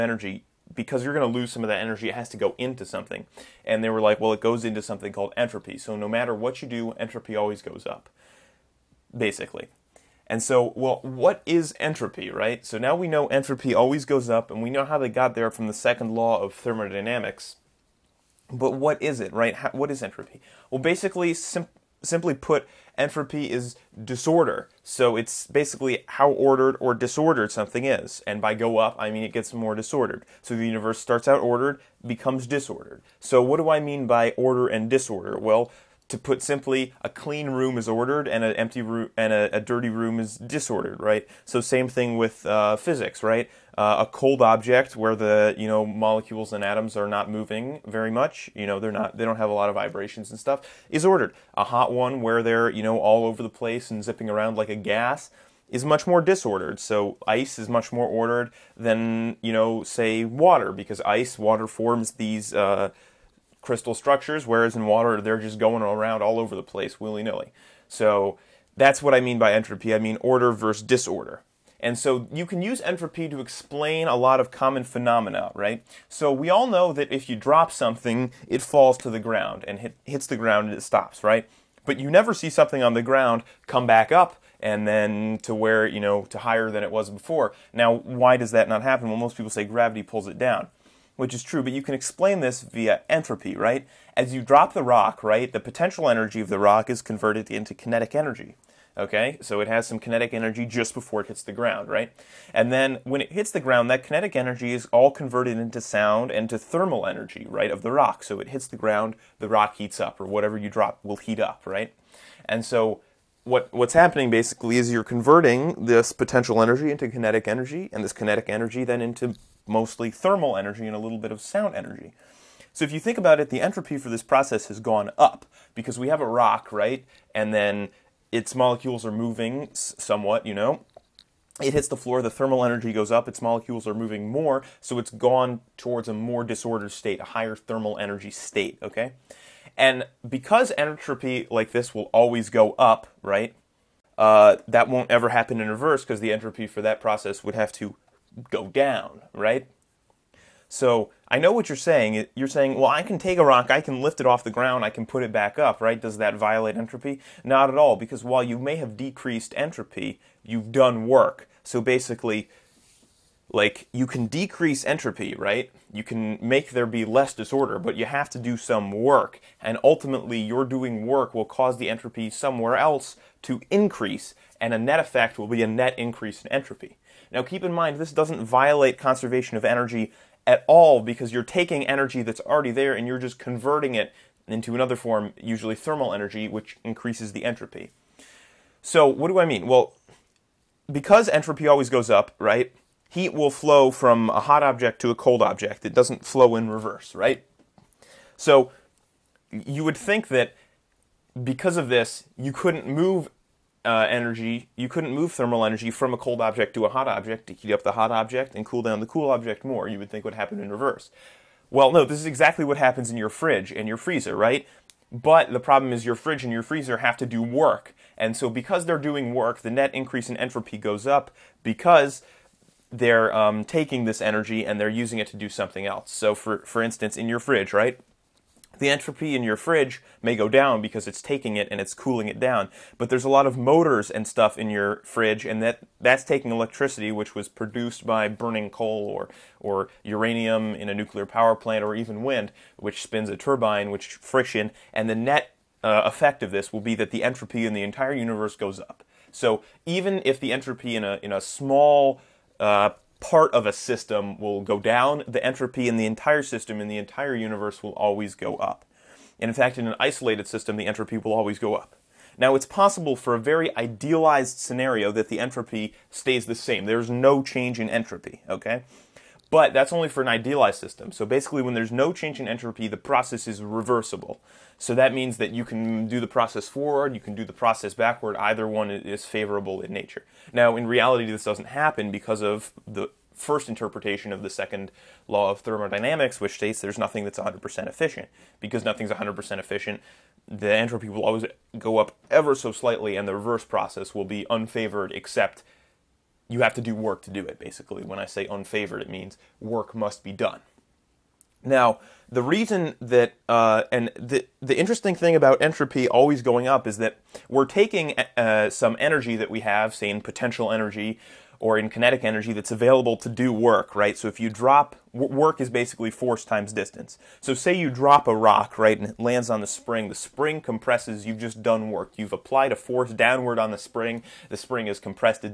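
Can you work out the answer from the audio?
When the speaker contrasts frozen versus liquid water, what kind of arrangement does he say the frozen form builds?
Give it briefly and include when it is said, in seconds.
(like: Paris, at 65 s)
crystal structures, at 63 s.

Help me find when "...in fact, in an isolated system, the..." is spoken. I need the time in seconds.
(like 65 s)
259 s.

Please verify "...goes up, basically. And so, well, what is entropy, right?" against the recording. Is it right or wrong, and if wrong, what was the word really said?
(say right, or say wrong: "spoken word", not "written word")
right.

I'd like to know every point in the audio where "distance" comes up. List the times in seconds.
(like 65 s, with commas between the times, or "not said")
316 s.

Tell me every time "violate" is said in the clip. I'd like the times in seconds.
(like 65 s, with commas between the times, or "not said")
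156 s, 178 s.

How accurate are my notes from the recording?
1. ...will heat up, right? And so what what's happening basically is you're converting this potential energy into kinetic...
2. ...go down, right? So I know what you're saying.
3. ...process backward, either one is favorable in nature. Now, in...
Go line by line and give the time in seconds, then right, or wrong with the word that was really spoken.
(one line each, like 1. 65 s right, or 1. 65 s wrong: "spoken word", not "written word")
1. 111 s right
2. 148 s right
3. 277 s right.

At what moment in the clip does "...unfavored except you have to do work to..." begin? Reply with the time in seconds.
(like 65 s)
294 s.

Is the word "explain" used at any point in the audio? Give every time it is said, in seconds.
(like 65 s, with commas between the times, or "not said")
73 s, 91 s.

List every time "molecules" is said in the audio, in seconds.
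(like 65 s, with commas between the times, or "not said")
45 s, 128 s, 133 s.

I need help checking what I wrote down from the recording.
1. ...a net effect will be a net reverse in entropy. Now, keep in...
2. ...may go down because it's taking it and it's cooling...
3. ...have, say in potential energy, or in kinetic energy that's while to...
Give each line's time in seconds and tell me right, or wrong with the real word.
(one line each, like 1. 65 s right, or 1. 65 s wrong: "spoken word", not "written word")
1. 174 s wrong: "increase", not "reverse"
2. 230 s right
3. 309 s wrong: "available", not "while".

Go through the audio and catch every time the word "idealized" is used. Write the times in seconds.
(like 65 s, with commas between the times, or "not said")
263 s, 270 s.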